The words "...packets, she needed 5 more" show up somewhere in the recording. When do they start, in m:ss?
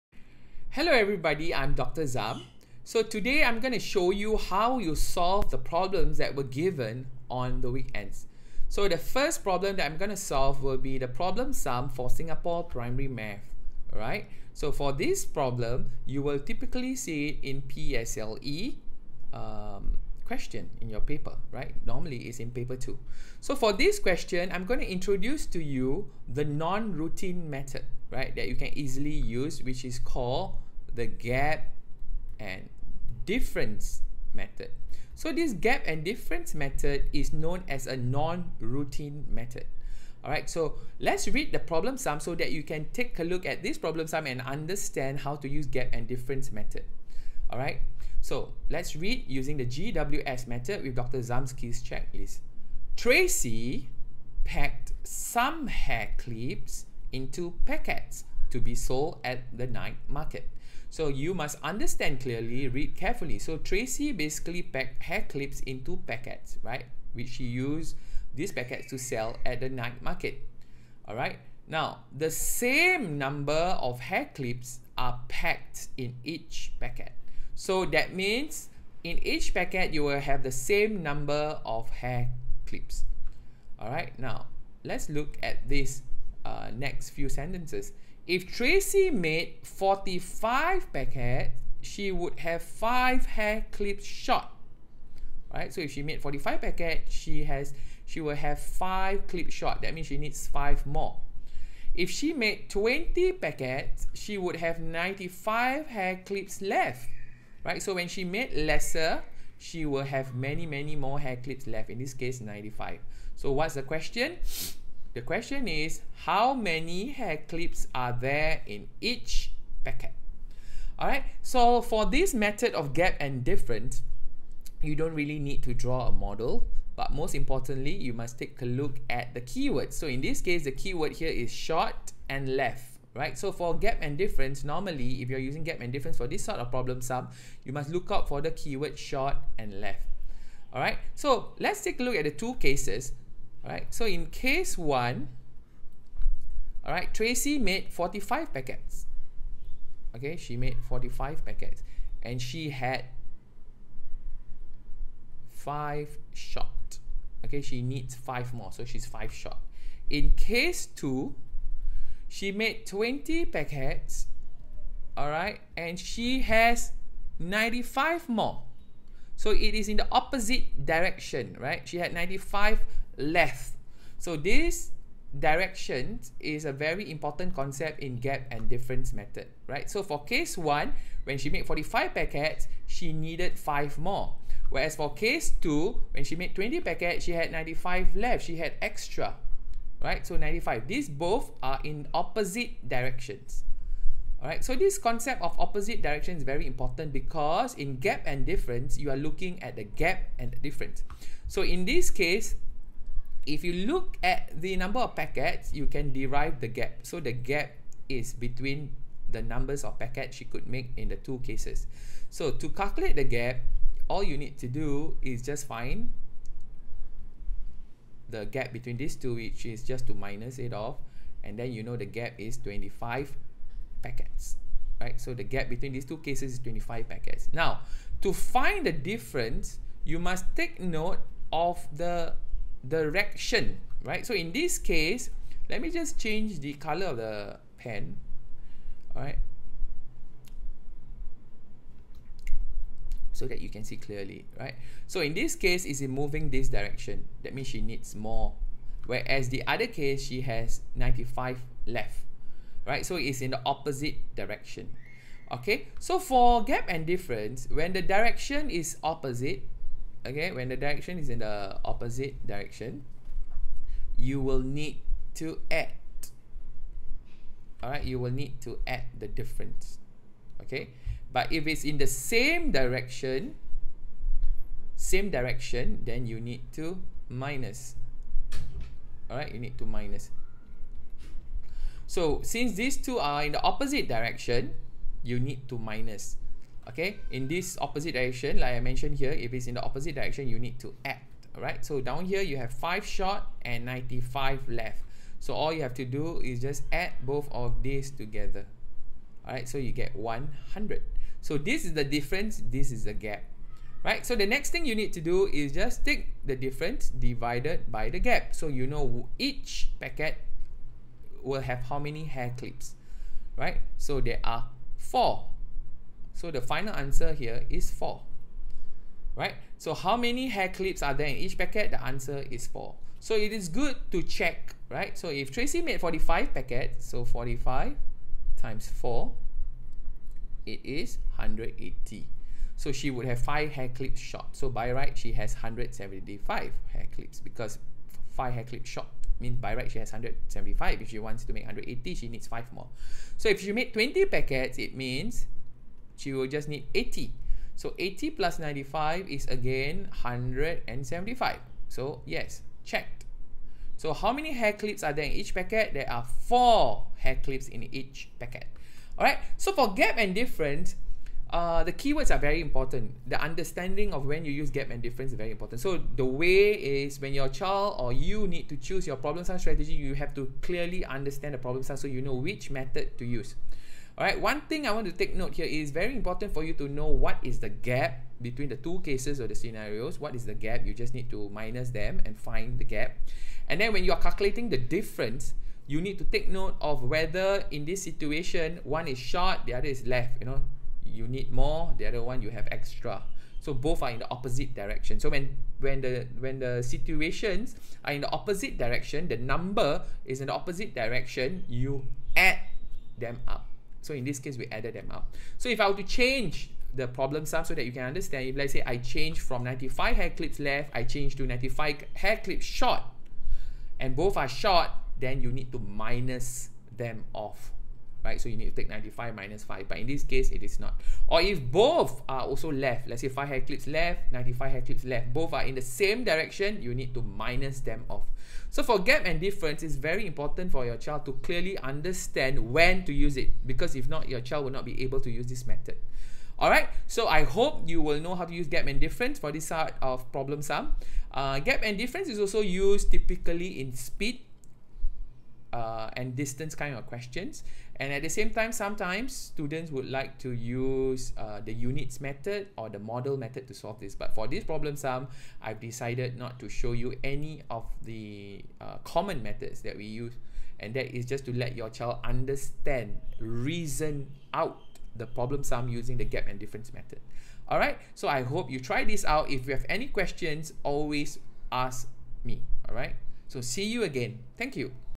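3:02.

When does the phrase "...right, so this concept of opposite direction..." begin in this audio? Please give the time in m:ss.
3:14.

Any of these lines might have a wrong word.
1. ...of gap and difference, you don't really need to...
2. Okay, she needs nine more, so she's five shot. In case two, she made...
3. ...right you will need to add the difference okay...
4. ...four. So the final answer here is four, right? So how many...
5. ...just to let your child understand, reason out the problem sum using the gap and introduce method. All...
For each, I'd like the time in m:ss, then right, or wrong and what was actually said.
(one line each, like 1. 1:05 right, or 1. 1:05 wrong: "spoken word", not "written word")
1. 2:02 right
2. 2:37 wrong: "five", not "nine"
3. 4:27 right
4. 5:14 right
5. 7:41 wrong: "difference", not "introduce".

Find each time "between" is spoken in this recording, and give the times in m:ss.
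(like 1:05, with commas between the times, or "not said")
3:28, 3:38, 3:45, 6:18.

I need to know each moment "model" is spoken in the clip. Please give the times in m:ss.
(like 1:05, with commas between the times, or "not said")
2:06, 7:32.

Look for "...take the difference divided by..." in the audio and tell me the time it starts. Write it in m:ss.
5:06.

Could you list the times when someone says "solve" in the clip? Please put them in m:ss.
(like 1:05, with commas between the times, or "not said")
0:04, 0:10, 7:33.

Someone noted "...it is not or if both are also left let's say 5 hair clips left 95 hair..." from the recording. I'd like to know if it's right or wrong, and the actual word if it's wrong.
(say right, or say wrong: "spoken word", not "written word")
right.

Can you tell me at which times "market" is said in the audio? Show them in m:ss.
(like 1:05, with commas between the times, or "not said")
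1:00, 1:10.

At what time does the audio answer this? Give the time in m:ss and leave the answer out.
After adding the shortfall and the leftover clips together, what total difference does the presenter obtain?
5:00.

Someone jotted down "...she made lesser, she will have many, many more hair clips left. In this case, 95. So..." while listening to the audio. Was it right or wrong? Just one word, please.
right.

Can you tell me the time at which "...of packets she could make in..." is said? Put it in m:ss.
3:29.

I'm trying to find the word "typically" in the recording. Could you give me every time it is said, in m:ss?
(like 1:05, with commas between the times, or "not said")
0:16, 7:23.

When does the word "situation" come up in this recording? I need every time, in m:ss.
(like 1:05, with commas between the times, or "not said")
6:28, 6:36.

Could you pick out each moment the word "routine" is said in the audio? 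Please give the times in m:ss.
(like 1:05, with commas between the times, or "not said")
0:26, 0:37.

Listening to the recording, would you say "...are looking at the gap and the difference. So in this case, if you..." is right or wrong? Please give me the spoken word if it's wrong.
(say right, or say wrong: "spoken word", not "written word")
right.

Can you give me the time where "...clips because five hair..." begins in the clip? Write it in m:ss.
5:37.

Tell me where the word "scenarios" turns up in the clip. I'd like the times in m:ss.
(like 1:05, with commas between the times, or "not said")
6:19.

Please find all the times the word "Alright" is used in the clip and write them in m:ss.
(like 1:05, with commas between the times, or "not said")
0:13, 0:40, 0:47, 2:00, 4:39, 4:51, 4:59, 7:16.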